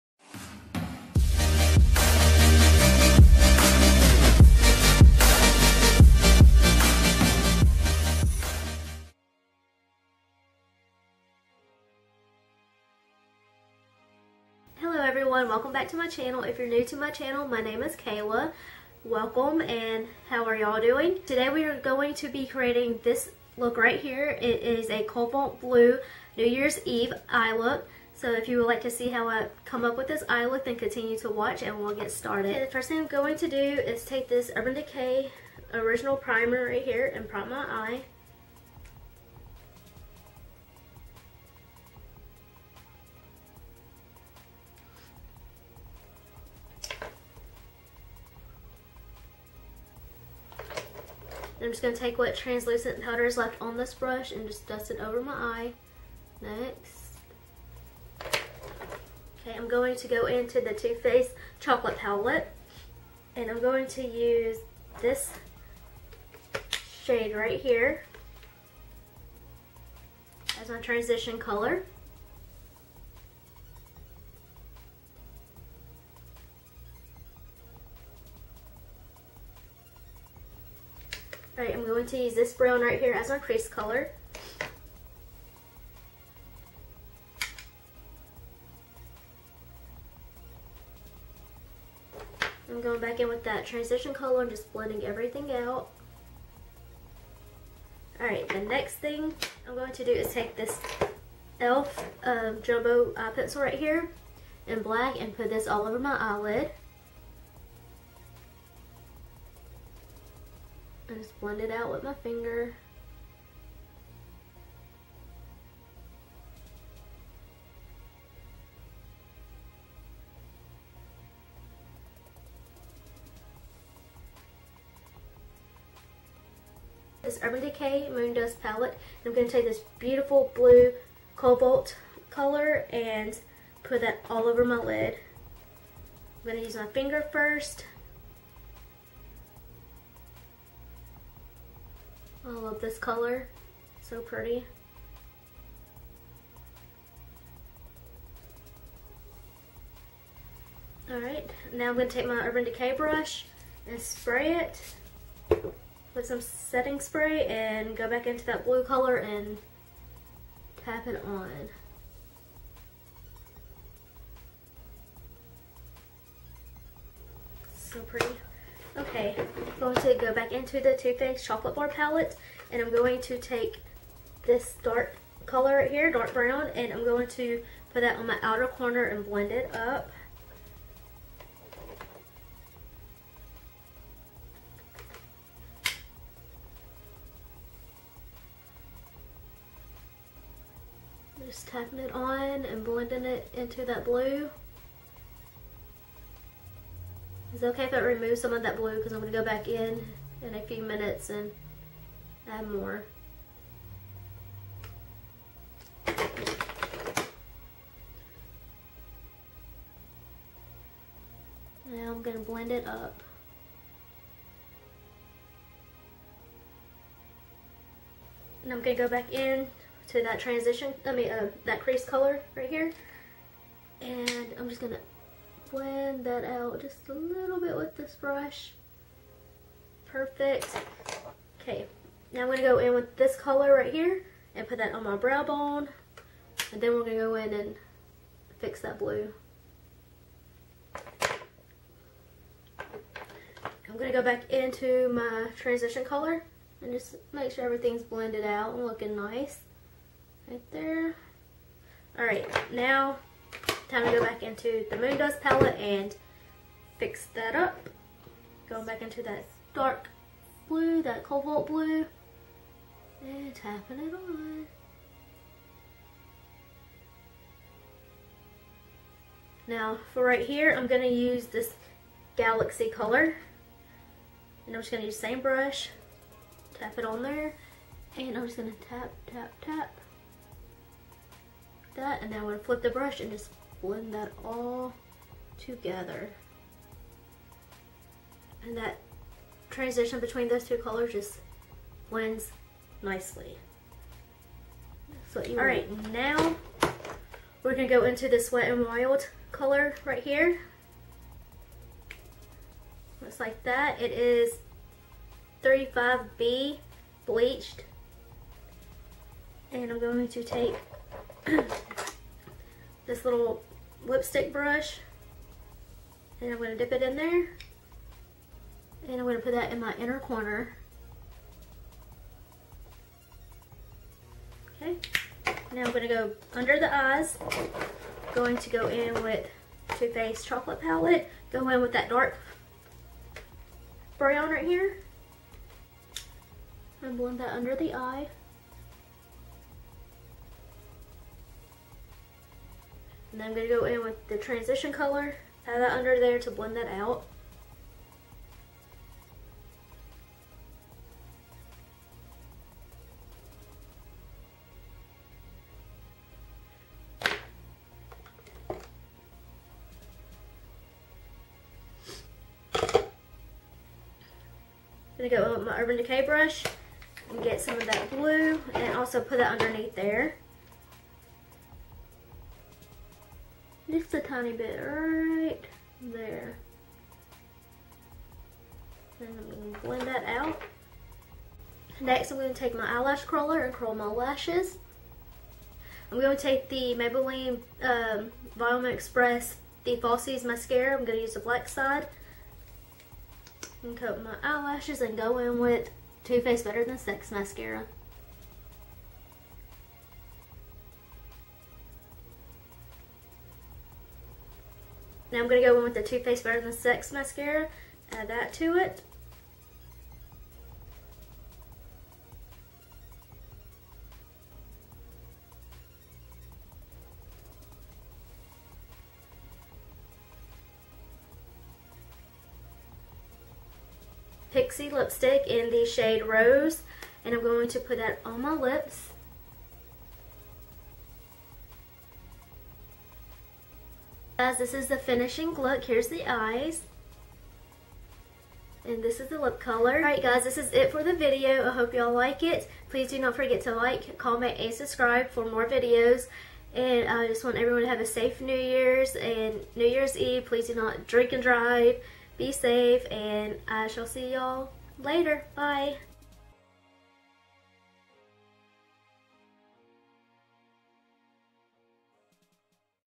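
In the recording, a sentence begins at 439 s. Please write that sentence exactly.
Alright guys, this is it for the video.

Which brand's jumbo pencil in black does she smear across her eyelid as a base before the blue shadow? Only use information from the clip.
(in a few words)
e.l.f.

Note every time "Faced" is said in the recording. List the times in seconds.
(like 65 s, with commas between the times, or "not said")
61 s, 171 s, 330 s, 396 s, 406 s.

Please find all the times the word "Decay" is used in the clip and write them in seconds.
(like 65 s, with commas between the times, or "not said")
34 s, 127 s, 152 s, 365 s.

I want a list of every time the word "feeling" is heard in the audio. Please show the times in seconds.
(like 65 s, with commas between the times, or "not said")
not said.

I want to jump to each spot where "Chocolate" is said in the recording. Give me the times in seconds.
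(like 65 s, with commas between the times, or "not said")
61 s, 171 s, 330 s.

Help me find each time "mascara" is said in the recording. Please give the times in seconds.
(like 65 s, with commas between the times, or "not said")
390 s, 397 s, 407 s.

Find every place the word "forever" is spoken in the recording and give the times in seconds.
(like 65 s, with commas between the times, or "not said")
not said.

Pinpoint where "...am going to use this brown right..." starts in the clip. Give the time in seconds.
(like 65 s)
81 s.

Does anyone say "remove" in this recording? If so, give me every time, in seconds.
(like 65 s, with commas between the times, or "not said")
197 s.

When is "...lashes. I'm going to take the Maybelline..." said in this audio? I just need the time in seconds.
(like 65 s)
384 s.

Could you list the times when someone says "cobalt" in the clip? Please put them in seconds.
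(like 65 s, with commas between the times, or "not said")
25 s, 131 s, 261 s.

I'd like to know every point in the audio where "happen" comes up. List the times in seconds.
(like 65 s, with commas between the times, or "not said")
not said.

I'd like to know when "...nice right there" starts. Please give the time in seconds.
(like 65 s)
249 s.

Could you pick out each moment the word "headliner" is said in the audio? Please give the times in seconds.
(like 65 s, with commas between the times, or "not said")
not said.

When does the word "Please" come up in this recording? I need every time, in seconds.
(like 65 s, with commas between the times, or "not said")
442 s, 450 s.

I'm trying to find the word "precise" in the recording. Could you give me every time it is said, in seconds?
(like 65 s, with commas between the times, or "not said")
not said.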